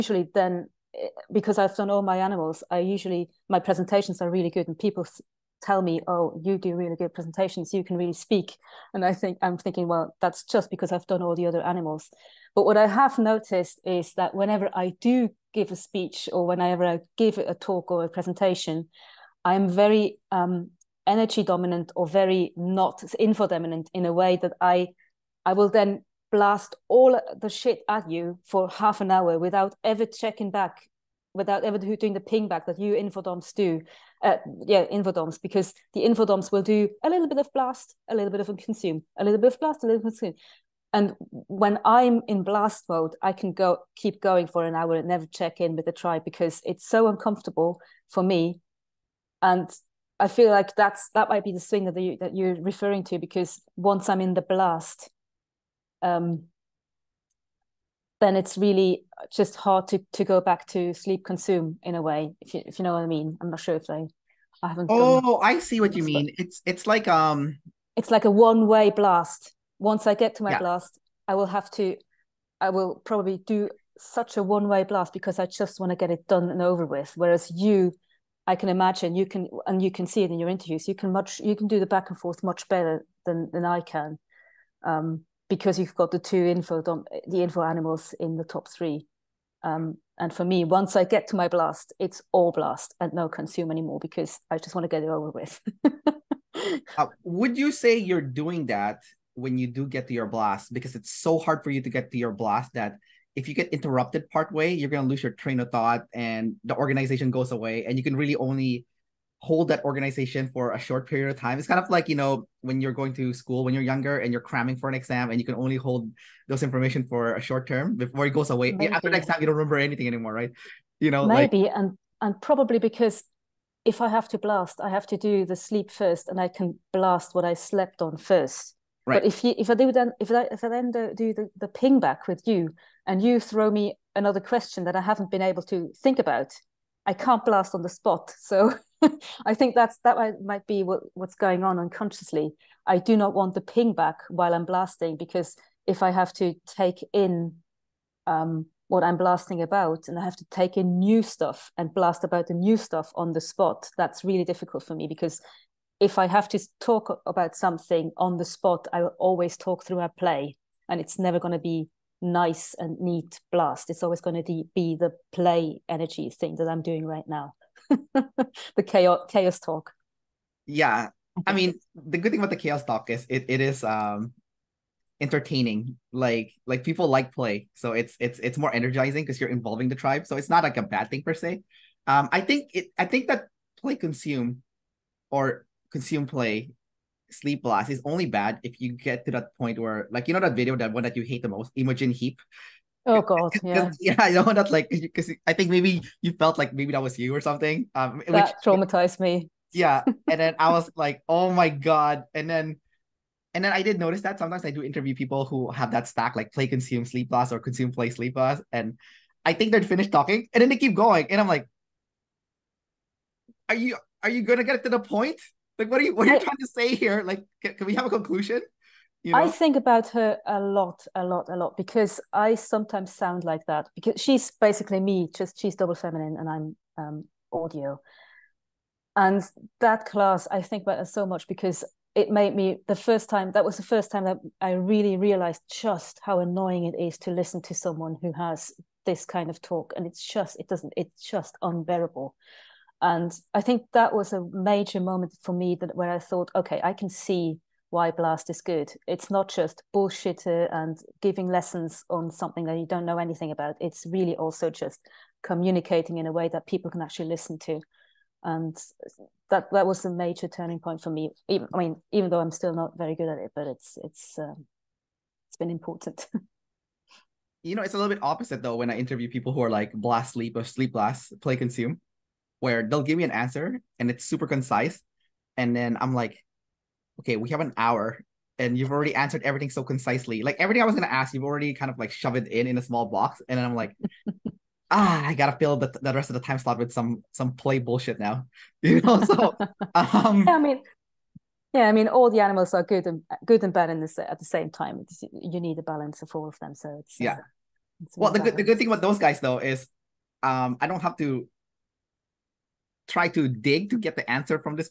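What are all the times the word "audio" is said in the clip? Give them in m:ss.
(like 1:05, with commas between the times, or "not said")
3:47.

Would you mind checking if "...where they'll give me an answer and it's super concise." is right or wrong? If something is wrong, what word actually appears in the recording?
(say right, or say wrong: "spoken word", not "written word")
right.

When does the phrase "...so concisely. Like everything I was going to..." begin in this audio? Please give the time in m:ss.
4:39.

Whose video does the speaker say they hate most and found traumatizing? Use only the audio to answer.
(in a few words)
Imogen Heap.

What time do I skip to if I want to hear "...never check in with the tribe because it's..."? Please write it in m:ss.
0:45.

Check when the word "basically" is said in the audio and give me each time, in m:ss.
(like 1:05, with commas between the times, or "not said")
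3:44.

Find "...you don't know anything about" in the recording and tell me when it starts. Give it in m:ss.
4:12.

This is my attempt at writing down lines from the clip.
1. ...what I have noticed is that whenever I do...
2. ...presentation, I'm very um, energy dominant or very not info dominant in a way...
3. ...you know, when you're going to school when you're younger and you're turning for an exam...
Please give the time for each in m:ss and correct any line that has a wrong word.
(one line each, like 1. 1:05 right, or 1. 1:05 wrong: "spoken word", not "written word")
1. 0:12 right
2. 0:18 right
3. 1:52 wrong: "cramming", not "turning".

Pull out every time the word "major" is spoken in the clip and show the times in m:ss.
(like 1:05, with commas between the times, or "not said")
4:04, 4:20.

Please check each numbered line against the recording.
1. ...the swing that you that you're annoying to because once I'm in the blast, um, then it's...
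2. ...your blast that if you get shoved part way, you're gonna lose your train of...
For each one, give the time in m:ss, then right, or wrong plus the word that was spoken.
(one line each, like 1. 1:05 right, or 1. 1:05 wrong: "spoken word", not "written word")
1. 0:51 wrong: "referring", not "annoying"
2. 1:42 wrong: "interrupted", not "shoved".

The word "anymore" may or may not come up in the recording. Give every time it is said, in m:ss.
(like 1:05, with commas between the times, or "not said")
1:33, 2:00.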